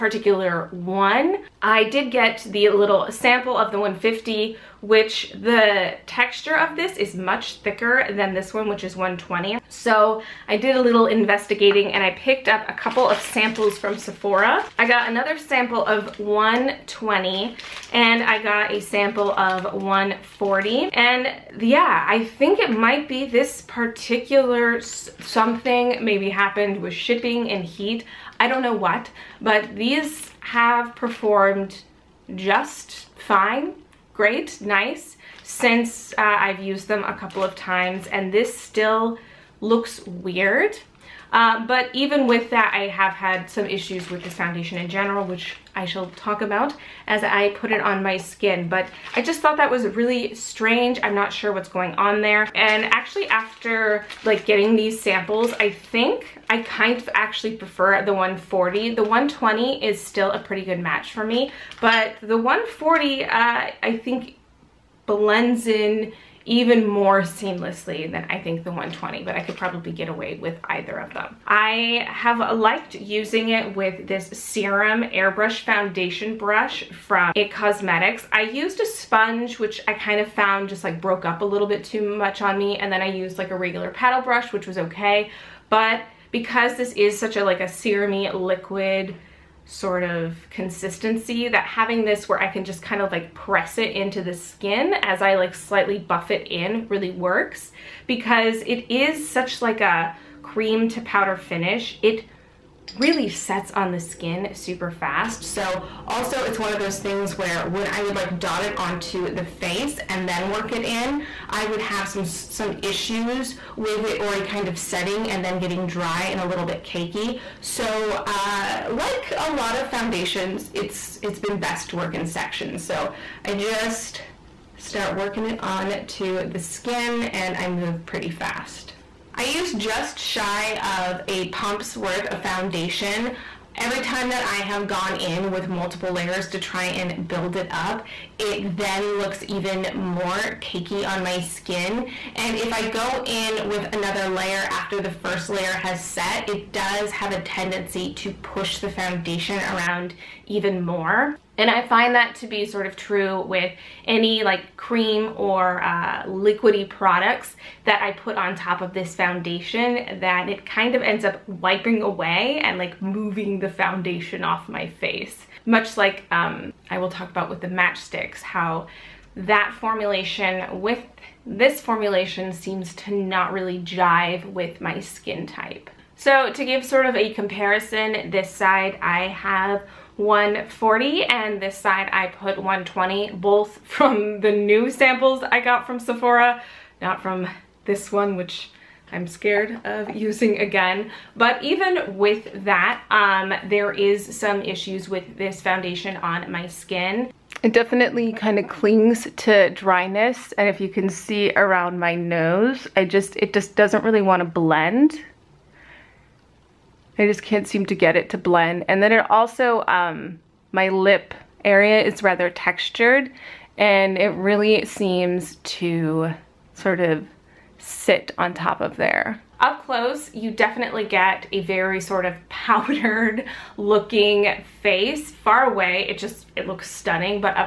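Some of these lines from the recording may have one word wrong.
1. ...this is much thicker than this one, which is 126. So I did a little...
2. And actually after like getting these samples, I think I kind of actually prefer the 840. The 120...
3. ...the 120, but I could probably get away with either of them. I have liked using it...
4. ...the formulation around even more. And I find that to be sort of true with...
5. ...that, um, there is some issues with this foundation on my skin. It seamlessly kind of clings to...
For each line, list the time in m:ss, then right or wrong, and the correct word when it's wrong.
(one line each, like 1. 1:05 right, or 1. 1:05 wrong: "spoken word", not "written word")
1. 0:06 wrong: "120", not "126"
2. 0:52 wrong: "140", not "840"
3. 1:08 right
4. 2:28 wrong: "foundation", not "formulation"
5. 3:12 wrong: "definitely", not "seamlessly".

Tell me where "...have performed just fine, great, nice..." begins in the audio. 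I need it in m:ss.
0:30.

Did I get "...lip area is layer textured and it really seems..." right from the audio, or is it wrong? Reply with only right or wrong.
wrong.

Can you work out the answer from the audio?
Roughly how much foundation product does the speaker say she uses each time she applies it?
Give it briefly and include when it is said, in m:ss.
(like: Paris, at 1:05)
just shy of a pump, at 2:09.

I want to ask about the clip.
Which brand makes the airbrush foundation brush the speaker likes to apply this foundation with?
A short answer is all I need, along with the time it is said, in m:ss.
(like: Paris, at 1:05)
It Cosmetics, at 1:17.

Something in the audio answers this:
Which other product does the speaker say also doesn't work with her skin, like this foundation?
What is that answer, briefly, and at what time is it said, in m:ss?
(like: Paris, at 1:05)
Match Stix, at 2:47.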